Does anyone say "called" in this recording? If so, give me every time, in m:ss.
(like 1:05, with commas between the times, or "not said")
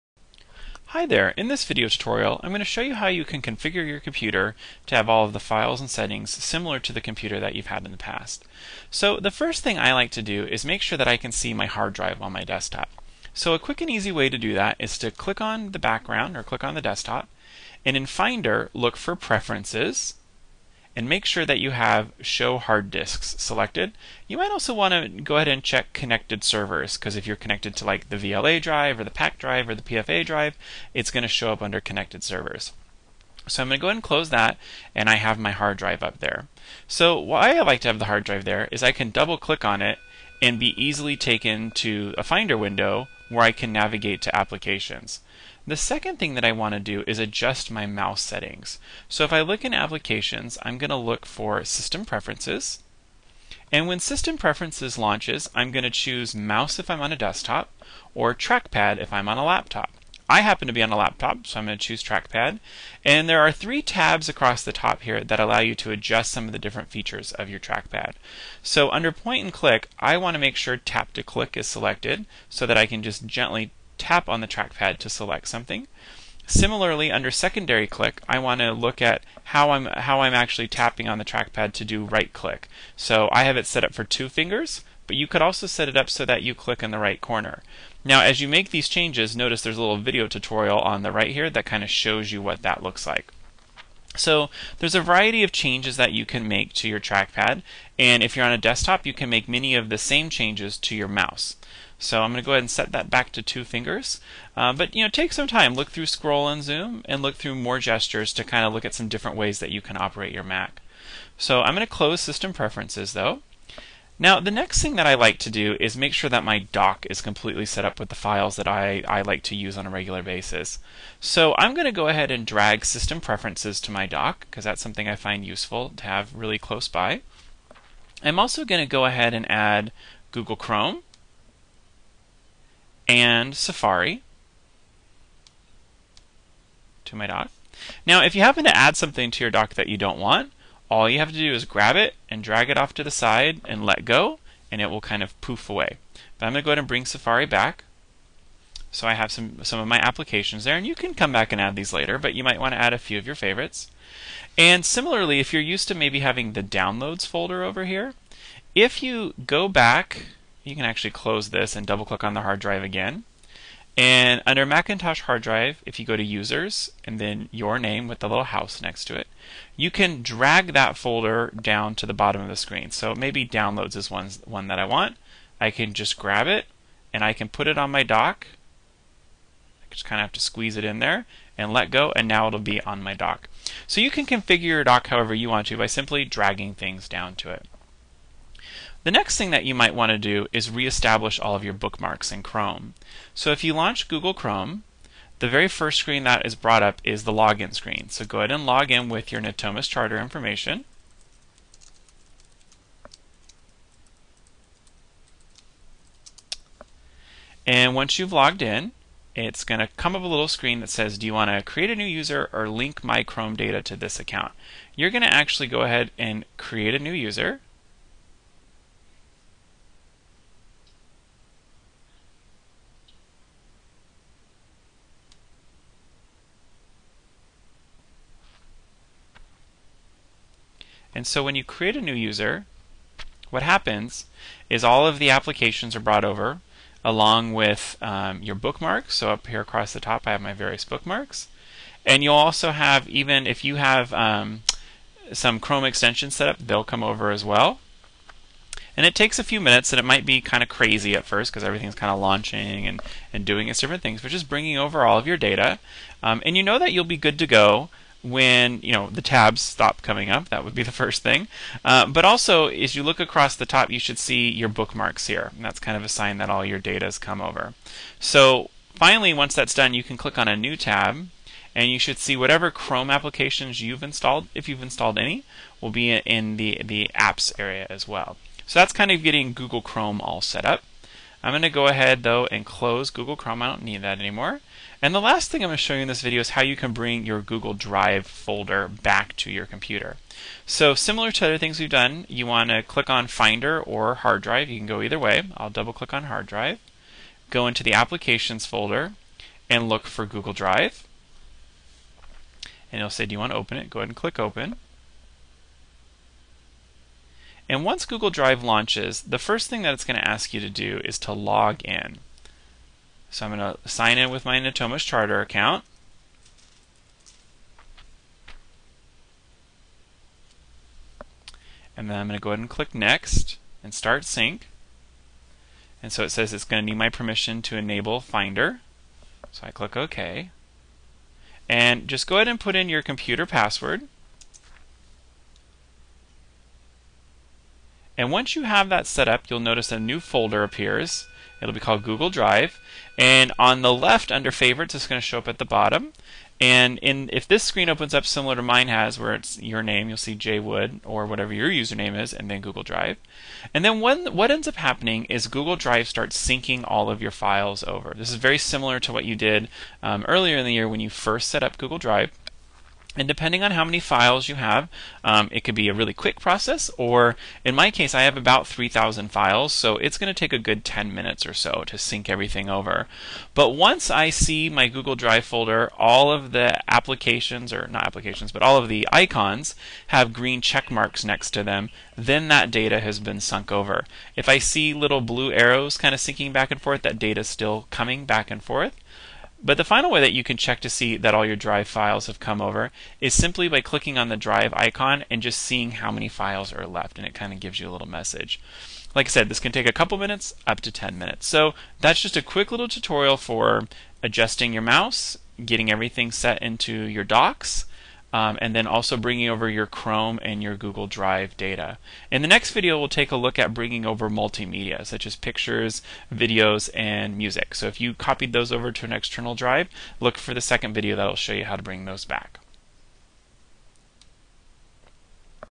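5:41.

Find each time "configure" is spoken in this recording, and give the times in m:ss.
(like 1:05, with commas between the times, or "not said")
0:03, 3:04.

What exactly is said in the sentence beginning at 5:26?
And so it says it's going to need my permission to enable Finder.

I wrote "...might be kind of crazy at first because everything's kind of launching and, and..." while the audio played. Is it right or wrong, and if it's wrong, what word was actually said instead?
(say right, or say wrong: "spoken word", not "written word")
right.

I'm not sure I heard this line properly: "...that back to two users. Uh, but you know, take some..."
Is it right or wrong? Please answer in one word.
wrong.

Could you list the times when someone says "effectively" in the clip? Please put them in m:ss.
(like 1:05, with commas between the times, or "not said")
not said.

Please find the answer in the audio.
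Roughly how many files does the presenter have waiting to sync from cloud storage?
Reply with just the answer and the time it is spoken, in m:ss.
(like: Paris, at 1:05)
3,000, at 6:08.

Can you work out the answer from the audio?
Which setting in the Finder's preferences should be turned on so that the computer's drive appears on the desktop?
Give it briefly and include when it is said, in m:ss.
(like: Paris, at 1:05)
Show hard disks, at 0:22.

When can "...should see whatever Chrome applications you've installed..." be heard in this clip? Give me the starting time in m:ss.
4:31.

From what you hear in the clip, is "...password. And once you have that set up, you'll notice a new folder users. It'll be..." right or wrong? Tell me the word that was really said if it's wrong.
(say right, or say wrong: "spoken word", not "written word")
wrong: "appears", not "users".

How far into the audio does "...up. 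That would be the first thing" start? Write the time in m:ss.
4:20.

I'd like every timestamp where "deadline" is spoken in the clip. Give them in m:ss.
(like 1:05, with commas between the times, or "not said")
not said.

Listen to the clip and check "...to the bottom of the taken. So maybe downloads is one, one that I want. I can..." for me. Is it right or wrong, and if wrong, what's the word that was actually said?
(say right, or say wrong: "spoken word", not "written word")
wrong: "screen", not "taken".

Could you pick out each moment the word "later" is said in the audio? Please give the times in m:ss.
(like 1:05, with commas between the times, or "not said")
2:31.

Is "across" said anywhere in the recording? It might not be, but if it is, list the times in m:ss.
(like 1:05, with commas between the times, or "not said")
1:04, 3:59, 4:23.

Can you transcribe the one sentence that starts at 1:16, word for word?
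Similarly, under secondary click, I want to look at how I'm, how I'm actually tapping on the trackpad to do right click.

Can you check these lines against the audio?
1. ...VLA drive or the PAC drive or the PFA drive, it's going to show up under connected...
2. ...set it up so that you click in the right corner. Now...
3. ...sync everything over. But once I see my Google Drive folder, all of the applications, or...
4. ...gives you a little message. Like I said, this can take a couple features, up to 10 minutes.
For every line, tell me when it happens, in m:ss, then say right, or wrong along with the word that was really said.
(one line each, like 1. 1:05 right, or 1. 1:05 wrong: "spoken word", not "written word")
1. 0:28 right
2. 1:25 right
3. 6:11 right
4. 6:37 wrong: "minutes", not "features".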